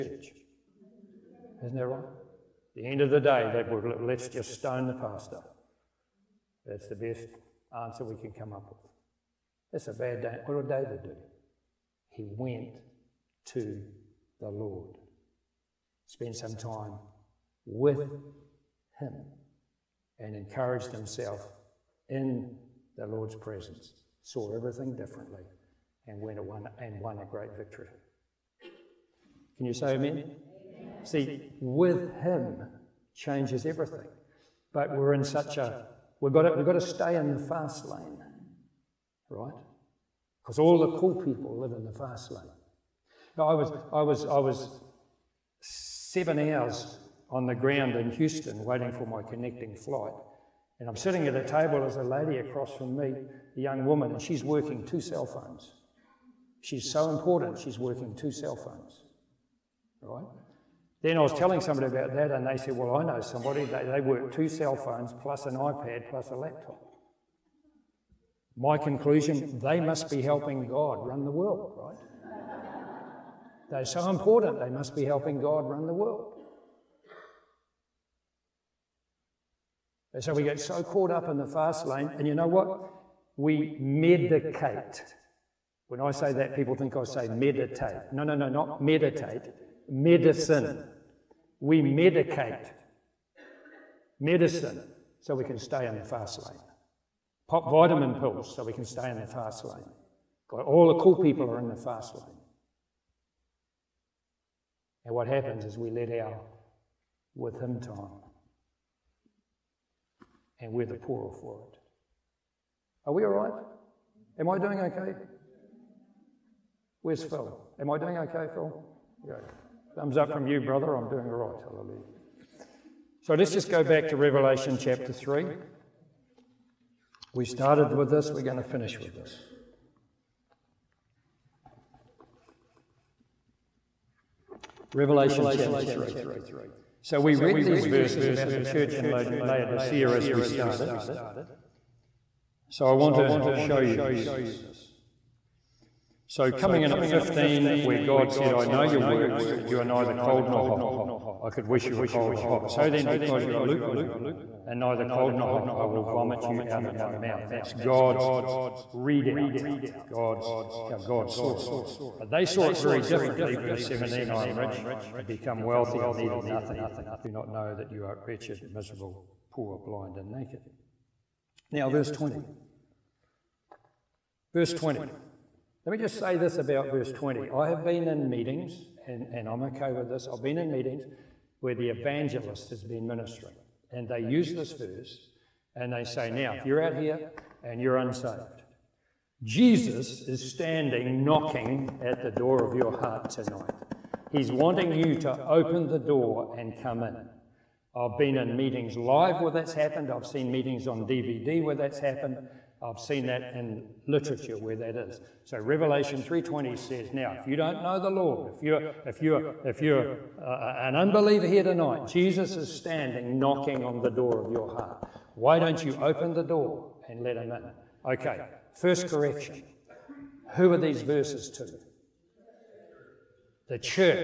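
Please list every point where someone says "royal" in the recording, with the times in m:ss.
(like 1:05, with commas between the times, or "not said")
not said.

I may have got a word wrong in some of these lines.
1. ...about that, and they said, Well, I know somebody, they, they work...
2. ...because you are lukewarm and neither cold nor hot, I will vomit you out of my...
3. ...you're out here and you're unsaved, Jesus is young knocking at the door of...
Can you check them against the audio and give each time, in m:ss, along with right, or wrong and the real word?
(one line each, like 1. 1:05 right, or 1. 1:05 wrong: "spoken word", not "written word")
1. 1:01 right
2. 2:33 right
3. 3:06 wrong: "standing", not "young".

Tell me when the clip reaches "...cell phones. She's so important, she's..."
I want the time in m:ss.
0:55.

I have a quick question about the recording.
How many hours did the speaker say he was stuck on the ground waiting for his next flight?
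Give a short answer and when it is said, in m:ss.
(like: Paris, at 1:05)
7, at 0:45.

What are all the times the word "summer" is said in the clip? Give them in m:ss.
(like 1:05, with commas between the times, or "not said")
not said.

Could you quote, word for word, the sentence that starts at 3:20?
I've seen meetings on DVD where that's happened.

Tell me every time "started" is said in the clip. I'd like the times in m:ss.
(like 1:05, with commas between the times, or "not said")
2:07, 2:20.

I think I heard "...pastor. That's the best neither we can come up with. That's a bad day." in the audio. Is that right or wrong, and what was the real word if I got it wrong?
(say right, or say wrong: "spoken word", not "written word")
wrong: "answer", not "neither".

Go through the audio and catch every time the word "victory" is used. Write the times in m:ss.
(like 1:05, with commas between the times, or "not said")
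0:27.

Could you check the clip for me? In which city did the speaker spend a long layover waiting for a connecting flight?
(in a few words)
Houston.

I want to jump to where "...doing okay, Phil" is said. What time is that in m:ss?
1:57.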